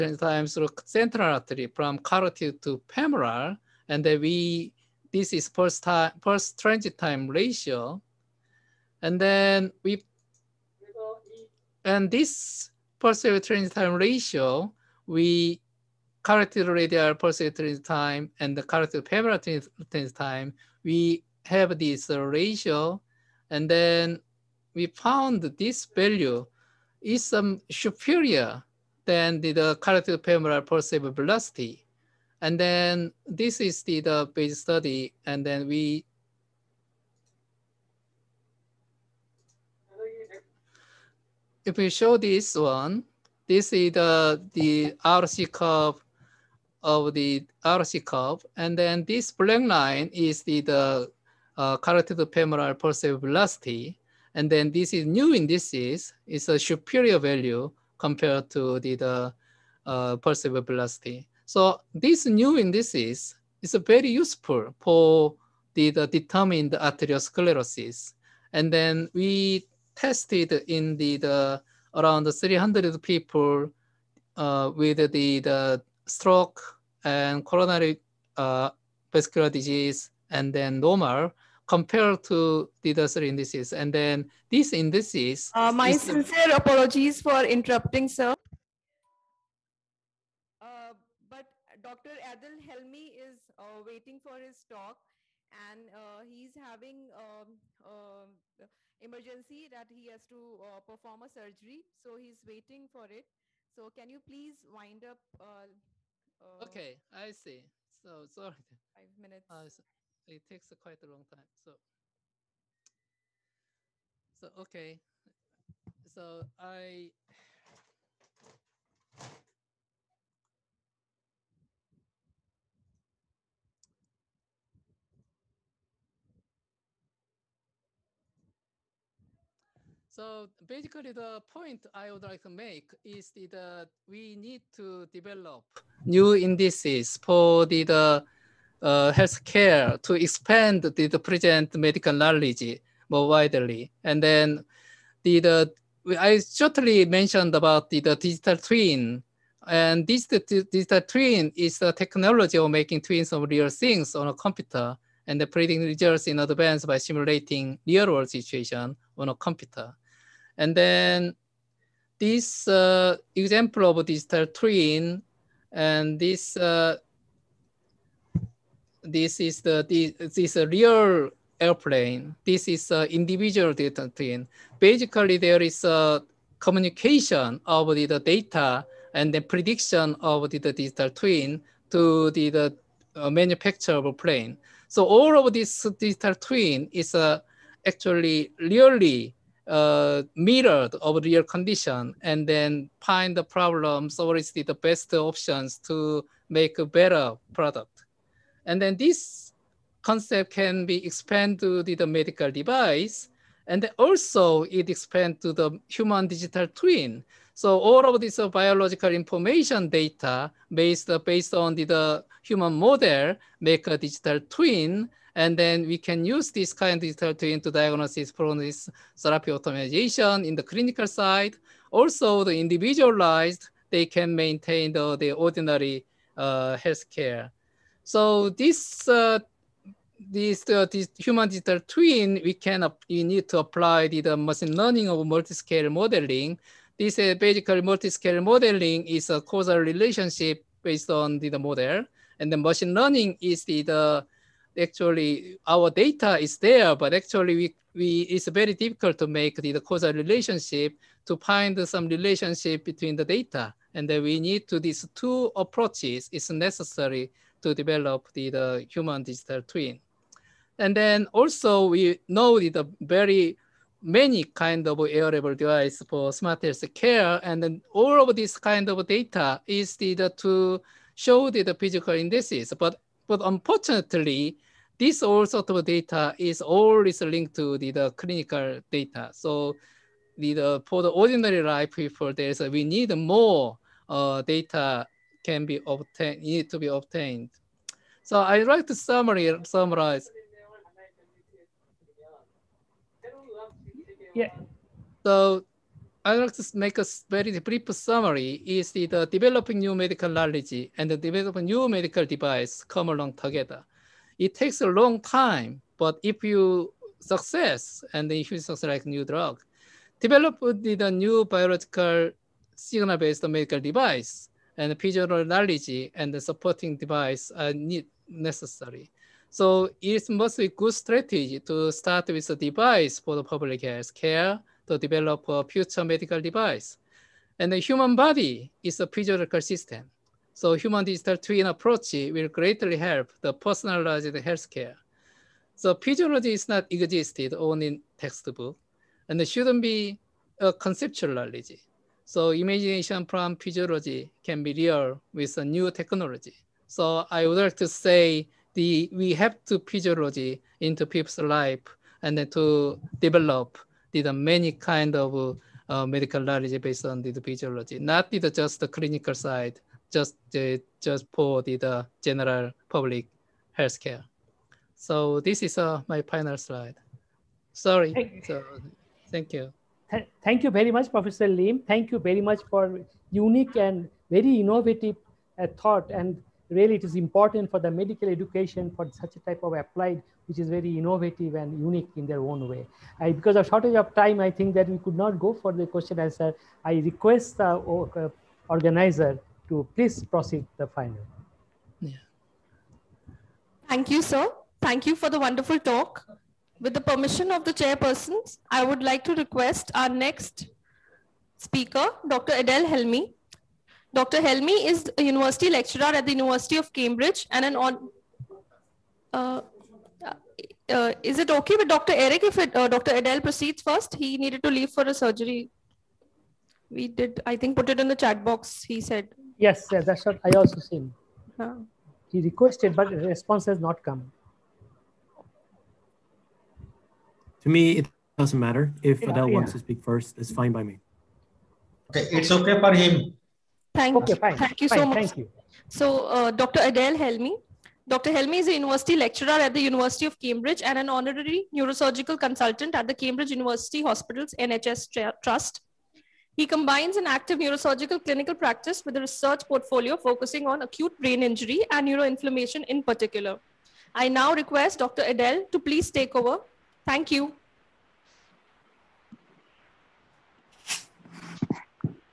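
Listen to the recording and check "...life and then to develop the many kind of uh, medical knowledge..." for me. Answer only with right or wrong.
right.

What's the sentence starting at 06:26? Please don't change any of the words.
I request the uh, organizer to please proceed the final.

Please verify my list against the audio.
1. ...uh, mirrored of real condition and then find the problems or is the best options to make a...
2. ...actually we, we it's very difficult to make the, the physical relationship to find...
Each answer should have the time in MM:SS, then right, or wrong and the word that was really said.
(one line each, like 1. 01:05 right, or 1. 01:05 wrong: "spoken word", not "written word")
1. 03:09 right
2. 04:07 wrong: "causal", not "physical".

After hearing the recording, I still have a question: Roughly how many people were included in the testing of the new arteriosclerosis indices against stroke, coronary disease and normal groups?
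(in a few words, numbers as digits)
300.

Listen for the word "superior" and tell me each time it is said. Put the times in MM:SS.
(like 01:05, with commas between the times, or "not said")
00:27, 00:56.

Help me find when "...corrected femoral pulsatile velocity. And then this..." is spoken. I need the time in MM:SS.
00:29.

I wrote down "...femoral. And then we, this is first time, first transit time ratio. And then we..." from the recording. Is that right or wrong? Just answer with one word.
right.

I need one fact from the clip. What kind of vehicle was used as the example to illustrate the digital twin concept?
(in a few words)
airplane.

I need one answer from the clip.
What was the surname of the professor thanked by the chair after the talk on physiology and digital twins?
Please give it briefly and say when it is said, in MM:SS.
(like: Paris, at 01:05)
Lim, at 06:11.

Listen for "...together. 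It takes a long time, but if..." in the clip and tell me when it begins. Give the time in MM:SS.
05:03.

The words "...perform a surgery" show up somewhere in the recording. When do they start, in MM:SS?
01:40.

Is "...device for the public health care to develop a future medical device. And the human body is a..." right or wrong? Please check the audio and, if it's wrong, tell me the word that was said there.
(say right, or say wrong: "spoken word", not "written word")
right.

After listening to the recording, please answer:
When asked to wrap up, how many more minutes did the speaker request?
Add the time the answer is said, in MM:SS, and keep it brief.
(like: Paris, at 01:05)
5, at 01:48.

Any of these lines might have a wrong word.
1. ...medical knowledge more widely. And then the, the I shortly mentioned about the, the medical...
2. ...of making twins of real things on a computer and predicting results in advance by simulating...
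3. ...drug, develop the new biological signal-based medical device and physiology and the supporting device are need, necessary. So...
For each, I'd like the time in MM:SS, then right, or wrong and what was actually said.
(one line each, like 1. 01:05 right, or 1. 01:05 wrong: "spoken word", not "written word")
1. 02:21 wrong: "digital", not "medical"
2. 02:32 right
3. 05:09 right.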